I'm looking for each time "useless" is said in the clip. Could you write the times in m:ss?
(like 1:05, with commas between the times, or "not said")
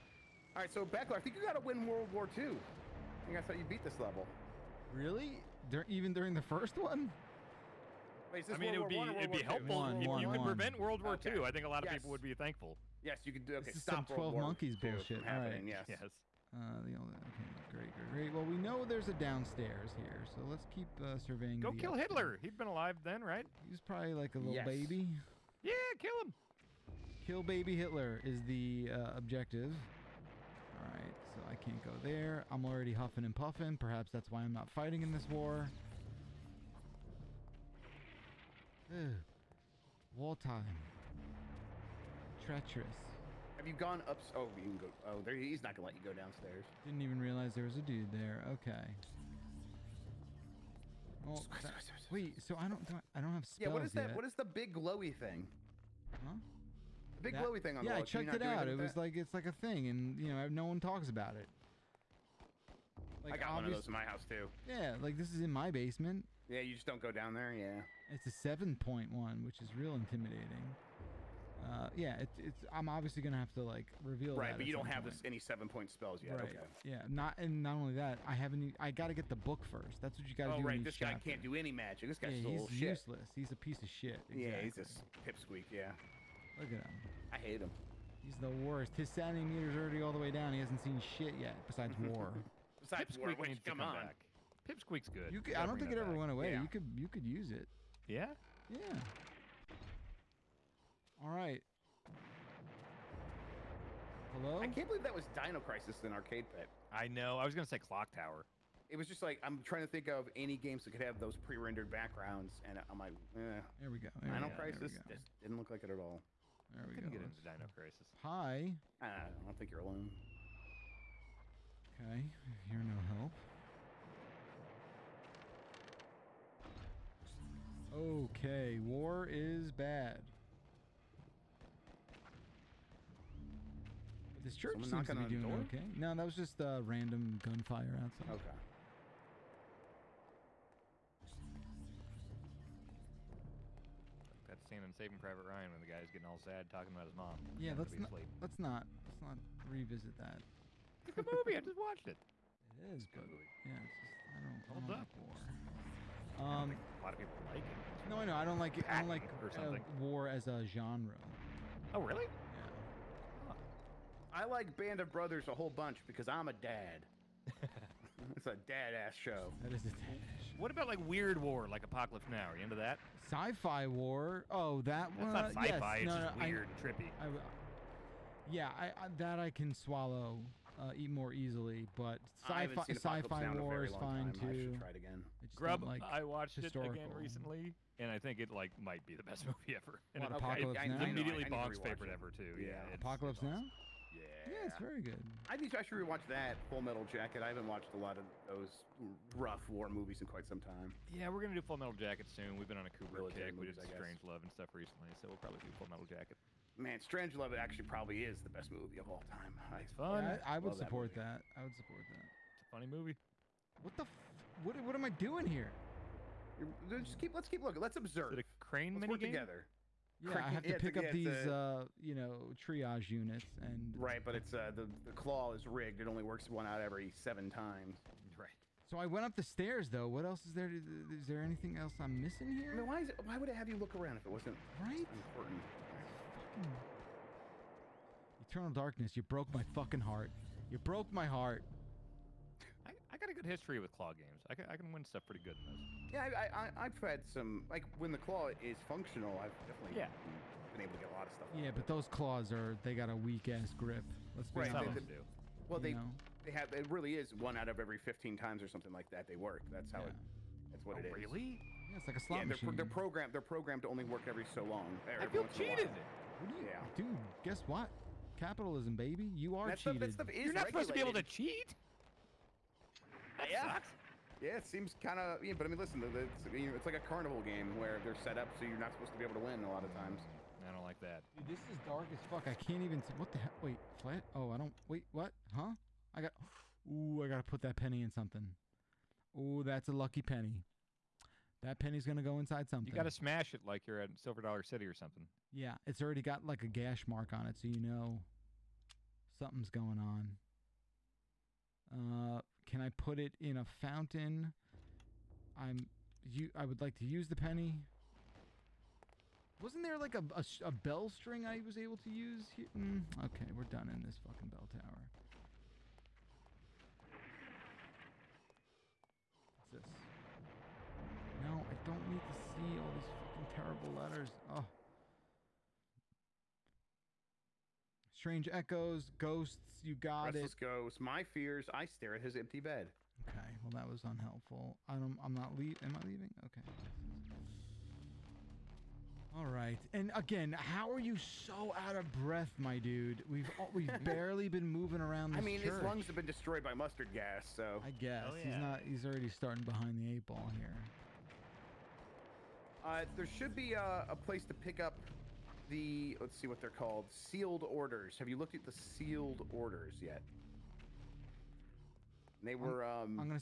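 1:22.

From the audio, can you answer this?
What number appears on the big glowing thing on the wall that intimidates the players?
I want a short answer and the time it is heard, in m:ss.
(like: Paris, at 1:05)
7.1, at 1:08.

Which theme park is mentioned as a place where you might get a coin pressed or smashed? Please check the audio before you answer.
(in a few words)
Silver Dollar City.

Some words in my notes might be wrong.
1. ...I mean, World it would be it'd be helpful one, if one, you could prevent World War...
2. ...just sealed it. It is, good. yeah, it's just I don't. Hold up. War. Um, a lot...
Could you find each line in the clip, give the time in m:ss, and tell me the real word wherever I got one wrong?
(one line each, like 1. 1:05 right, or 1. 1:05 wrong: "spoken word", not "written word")
1. 0:08 right
2. 2:31 wrong: "watched", not "sealed".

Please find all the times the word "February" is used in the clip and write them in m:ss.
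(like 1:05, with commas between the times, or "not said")
not said.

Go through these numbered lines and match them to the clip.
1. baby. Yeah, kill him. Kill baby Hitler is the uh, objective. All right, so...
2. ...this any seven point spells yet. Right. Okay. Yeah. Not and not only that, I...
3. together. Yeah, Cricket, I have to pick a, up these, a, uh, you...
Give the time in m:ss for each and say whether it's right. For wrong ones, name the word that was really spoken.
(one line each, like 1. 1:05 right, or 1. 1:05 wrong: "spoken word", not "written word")
1. 0:24 right
2. 1:15 right
3. 3:39 right.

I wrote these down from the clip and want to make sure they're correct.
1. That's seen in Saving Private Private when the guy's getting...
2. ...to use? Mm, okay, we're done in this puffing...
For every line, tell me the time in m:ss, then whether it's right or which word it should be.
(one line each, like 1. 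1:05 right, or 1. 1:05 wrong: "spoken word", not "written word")
1. 2:24 wrong: "Ryan", not "Private"
2. 5:11 wrong: "fucking", not "puffing".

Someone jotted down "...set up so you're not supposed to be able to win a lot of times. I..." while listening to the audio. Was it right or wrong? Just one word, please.
right.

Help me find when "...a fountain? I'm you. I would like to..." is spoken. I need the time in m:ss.
5:03.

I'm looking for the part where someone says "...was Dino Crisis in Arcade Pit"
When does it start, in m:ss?
1:45.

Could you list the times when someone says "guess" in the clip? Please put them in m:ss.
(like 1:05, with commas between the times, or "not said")
4:27, 5:47.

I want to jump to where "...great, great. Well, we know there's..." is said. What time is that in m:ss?
0:17.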